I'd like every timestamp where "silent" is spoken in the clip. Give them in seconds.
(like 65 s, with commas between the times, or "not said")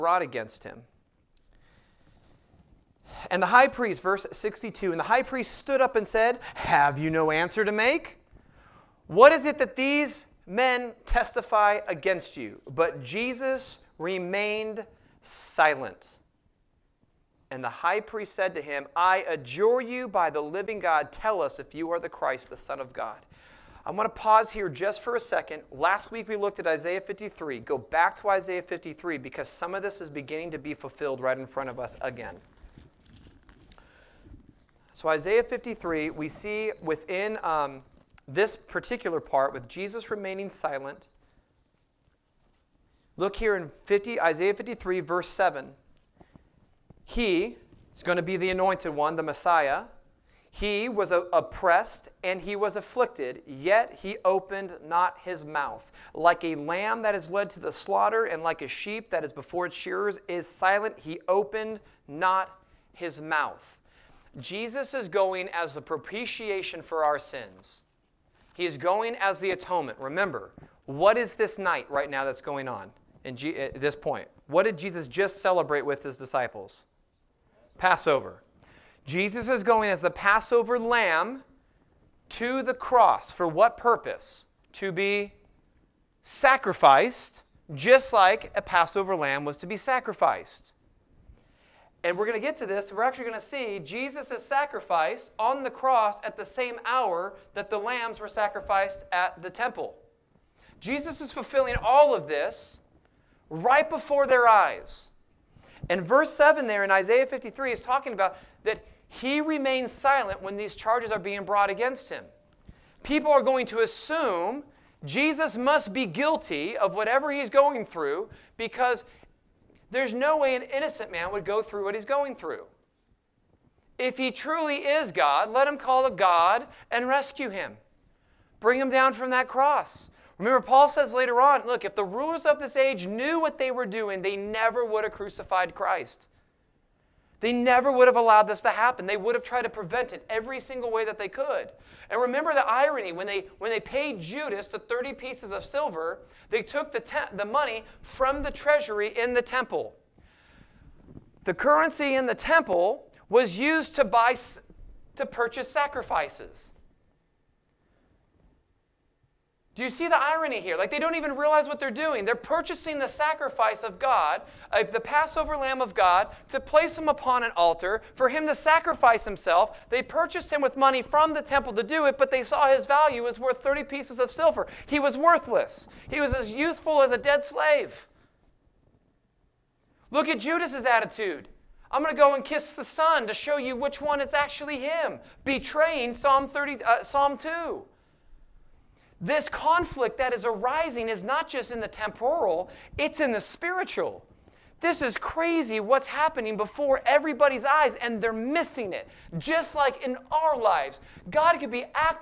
15 s, 40 s, 60 s, 109 s.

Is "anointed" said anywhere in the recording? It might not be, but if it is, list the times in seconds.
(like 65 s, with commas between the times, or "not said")
48 s.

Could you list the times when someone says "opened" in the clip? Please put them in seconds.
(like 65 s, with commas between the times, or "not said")
54 s, 61 s.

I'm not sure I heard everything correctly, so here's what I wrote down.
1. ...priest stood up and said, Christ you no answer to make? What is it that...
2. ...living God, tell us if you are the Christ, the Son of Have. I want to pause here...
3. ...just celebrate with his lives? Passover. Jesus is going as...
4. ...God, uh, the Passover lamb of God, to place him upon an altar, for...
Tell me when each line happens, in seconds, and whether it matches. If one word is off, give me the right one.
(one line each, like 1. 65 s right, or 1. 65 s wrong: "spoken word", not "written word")
1. 5 s wrong: "Have", not "Christ"
2. 20 s wrong: "God", not "Have"
3. 75 s wrong: "disciples", not "lives"
4. 163 s right.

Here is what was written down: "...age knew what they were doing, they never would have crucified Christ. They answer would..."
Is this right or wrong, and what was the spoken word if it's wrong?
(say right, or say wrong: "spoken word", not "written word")
wrong: "never", not "answer".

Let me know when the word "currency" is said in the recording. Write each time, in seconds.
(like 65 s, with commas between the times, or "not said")
151 s.